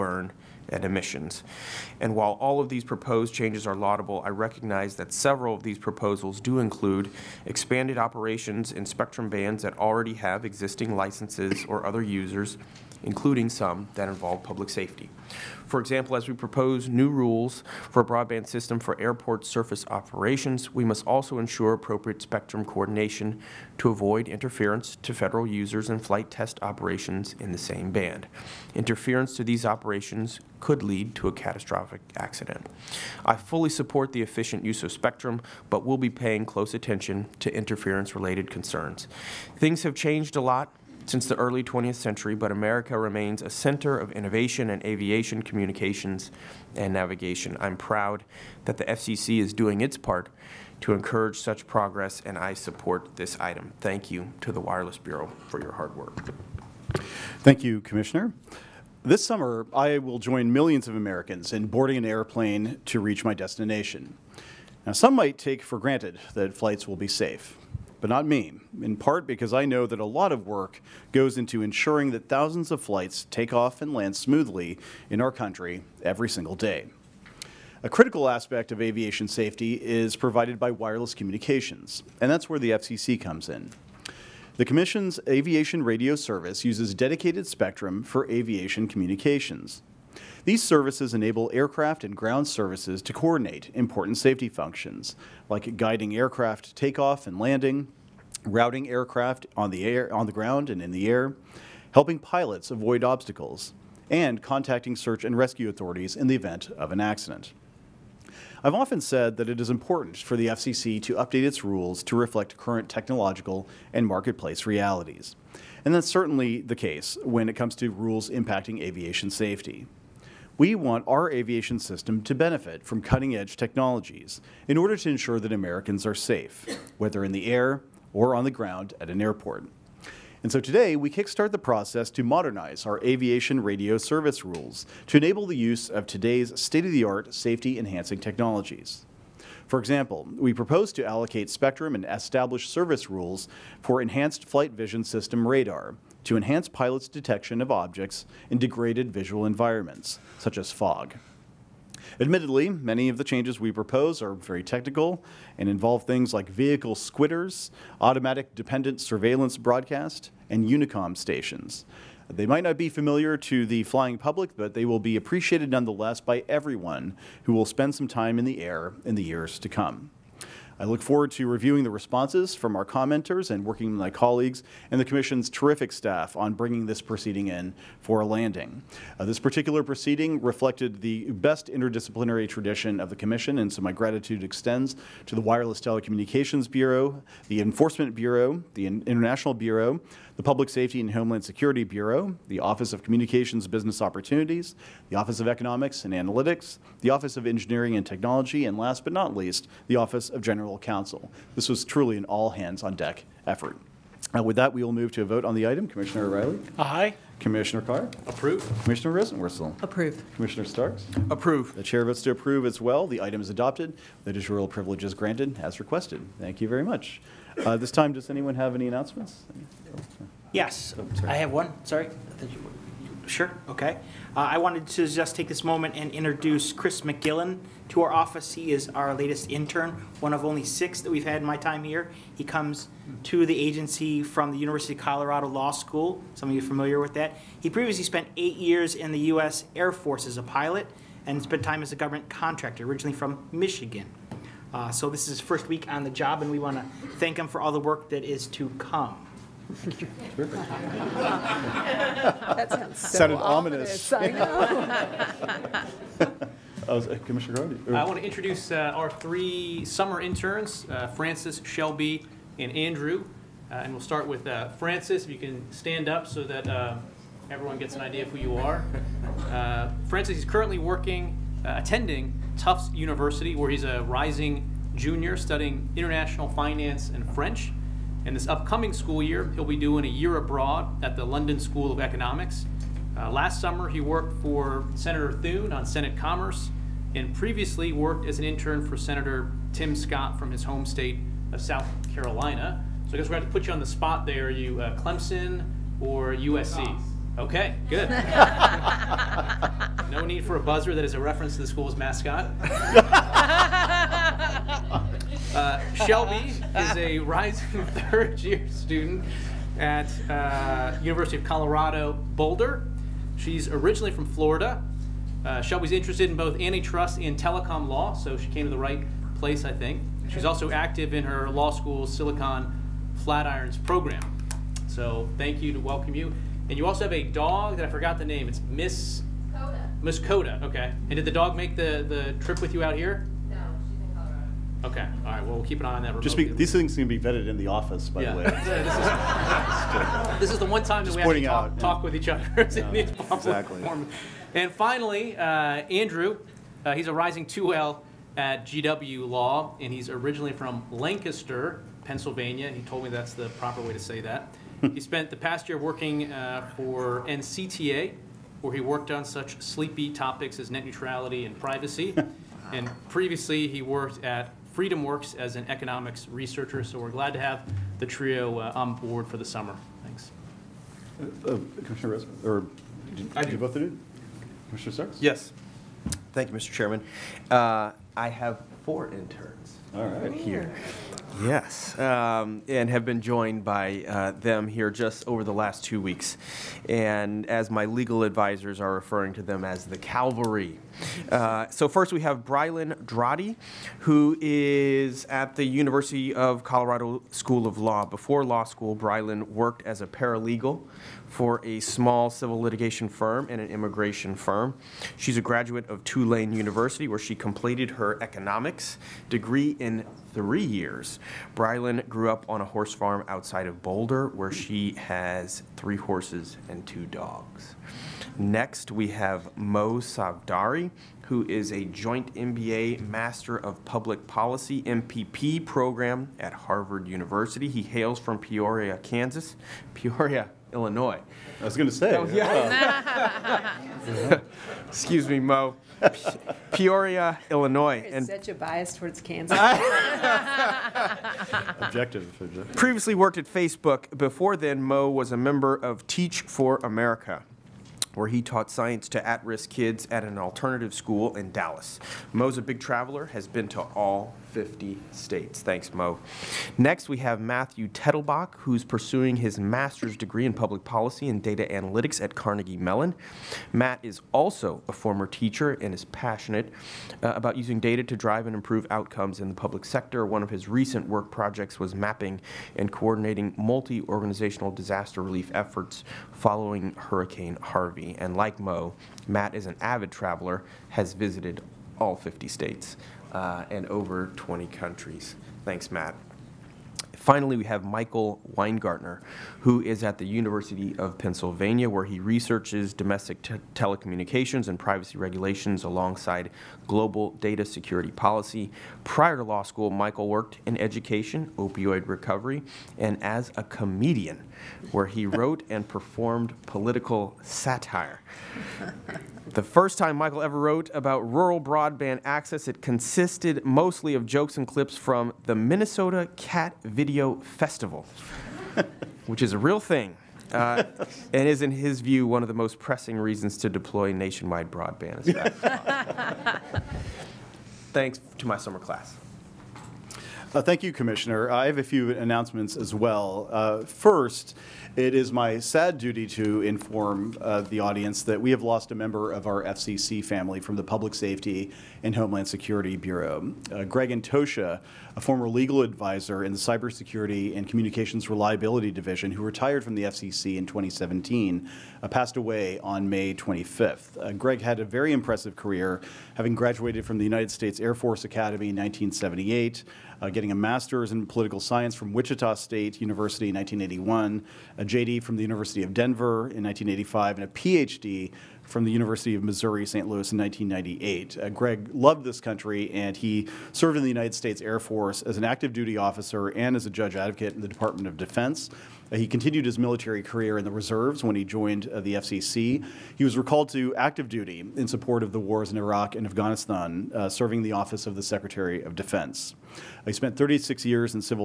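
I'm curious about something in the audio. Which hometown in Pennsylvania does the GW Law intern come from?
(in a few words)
Lancaster.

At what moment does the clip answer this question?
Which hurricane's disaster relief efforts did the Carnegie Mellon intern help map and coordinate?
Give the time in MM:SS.
07:56.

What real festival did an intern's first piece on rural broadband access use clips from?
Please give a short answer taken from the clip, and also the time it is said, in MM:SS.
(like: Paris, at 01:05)
Minnesota Cat Video Festival, at 08:35.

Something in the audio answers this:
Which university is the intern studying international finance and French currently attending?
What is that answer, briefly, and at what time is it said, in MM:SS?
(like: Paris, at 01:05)
Tufts University, at 04:32.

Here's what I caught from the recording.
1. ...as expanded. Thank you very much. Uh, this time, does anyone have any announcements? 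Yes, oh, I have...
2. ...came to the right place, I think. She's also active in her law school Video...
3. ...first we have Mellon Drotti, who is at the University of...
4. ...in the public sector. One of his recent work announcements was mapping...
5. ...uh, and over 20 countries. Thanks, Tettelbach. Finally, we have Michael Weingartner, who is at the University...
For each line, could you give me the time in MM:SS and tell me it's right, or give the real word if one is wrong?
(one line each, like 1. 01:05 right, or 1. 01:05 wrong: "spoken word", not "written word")
1. 03:35 wrong: "requested", not "expanded"
2. 05:18 wrong: "Silicon", not "Video"
3. 06:31 wrong: "Brylan", not "Mellon"
4. 07:49 wrong: "projects", not "announcements"
5. 08:03 wrong: "Matt", not "Tettelbach".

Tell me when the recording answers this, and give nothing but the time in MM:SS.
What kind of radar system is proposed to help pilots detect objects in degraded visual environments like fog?
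02:24.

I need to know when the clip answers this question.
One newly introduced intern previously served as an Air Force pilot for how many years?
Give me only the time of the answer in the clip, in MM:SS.
03:58.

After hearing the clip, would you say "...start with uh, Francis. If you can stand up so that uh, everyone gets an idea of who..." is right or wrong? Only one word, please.
right.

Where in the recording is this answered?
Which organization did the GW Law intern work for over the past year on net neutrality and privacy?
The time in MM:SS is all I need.
05:57.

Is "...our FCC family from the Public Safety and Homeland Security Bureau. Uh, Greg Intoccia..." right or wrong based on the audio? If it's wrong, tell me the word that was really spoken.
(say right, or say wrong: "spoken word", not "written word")
right.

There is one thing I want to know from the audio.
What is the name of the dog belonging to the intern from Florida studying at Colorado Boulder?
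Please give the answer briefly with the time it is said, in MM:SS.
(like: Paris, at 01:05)
Miss Coda, at 05:30.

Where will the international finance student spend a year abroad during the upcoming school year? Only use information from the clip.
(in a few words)
London School of Economics.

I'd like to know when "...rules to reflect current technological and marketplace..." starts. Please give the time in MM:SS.
01:51.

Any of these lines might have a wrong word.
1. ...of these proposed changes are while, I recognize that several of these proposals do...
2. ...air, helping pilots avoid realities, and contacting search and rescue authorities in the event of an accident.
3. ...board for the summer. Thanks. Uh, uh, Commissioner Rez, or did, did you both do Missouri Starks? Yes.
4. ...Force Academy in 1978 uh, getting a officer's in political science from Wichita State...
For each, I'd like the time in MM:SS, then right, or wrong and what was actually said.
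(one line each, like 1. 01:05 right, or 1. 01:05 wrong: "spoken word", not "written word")
1. 00:02 wrong: "laudable", not "while"
2. 01:41 wrong: "obstacles", not "realities"
3. 06:08 wrong: "Commissioner", not "Missouri"
4. 09:17 wrong: "master", not "officer".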